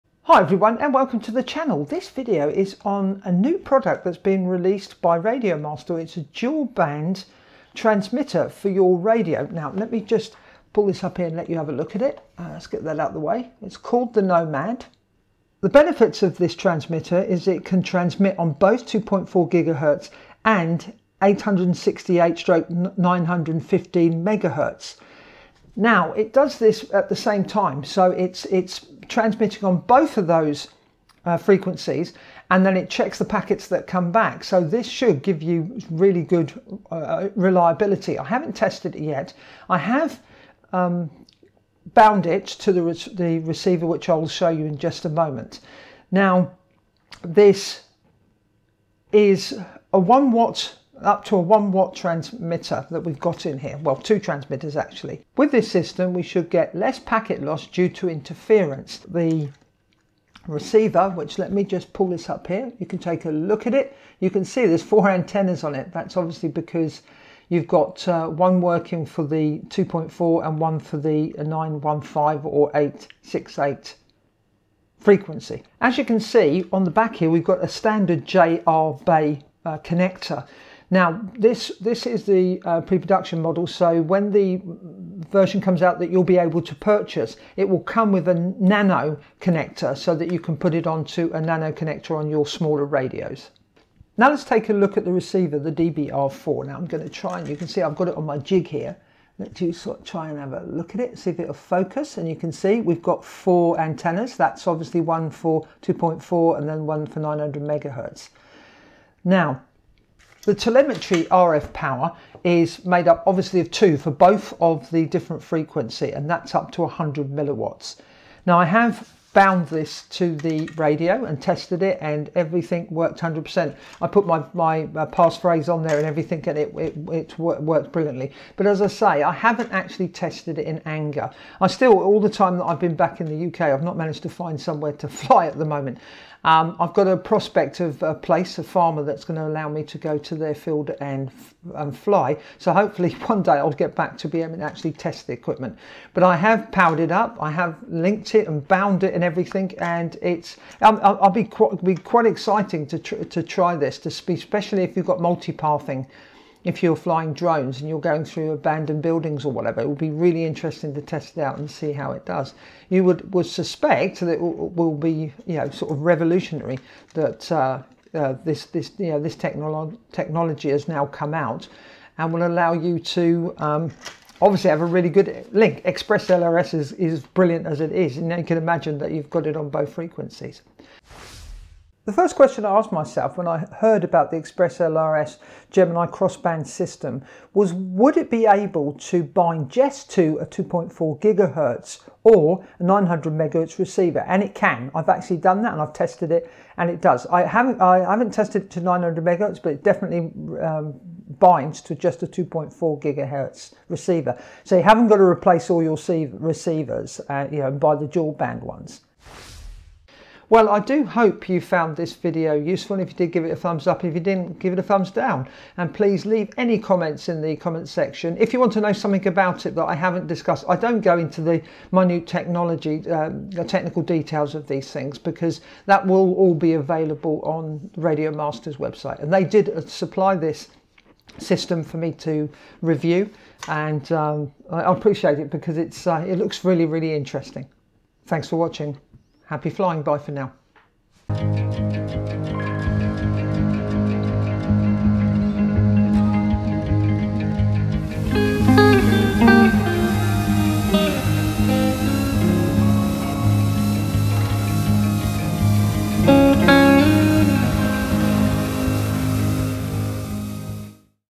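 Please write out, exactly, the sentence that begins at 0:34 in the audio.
So this should give you really good uh, uh reliability.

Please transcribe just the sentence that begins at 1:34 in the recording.
Now let's take a look at the receiver, the DBR4.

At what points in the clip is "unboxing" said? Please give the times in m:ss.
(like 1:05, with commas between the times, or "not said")
not said.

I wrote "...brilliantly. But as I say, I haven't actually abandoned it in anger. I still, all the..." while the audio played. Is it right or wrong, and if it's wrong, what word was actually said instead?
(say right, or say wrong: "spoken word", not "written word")
wrong: "tested", not "abandoned".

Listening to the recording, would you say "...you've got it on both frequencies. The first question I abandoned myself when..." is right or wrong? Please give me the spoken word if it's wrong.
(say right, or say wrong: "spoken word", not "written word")
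wrong: "asked", not "abandoned".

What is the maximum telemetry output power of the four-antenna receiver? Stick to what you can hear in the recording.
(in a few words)
100 milliwatts.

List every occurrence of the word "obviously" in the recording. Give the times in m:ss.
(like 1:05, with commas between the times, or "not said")
1:06, 1:44, 1:53, 2:54.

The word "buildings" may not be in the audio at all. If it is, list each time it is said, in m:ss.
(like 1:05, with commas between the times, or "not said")
2:39.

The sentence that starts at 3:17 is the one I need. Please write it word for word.
I haven't I haven't tested it to 900 megahertz, but it definitely um, binds to just a 2.4 gigahertz receiver.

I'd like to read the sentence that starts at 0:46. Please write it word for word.
Now, this is a one watt up to a 1 watt transmitter that we've got in here, well two transmitters actually.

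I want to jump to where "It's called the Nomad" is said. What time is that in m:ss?
0:13.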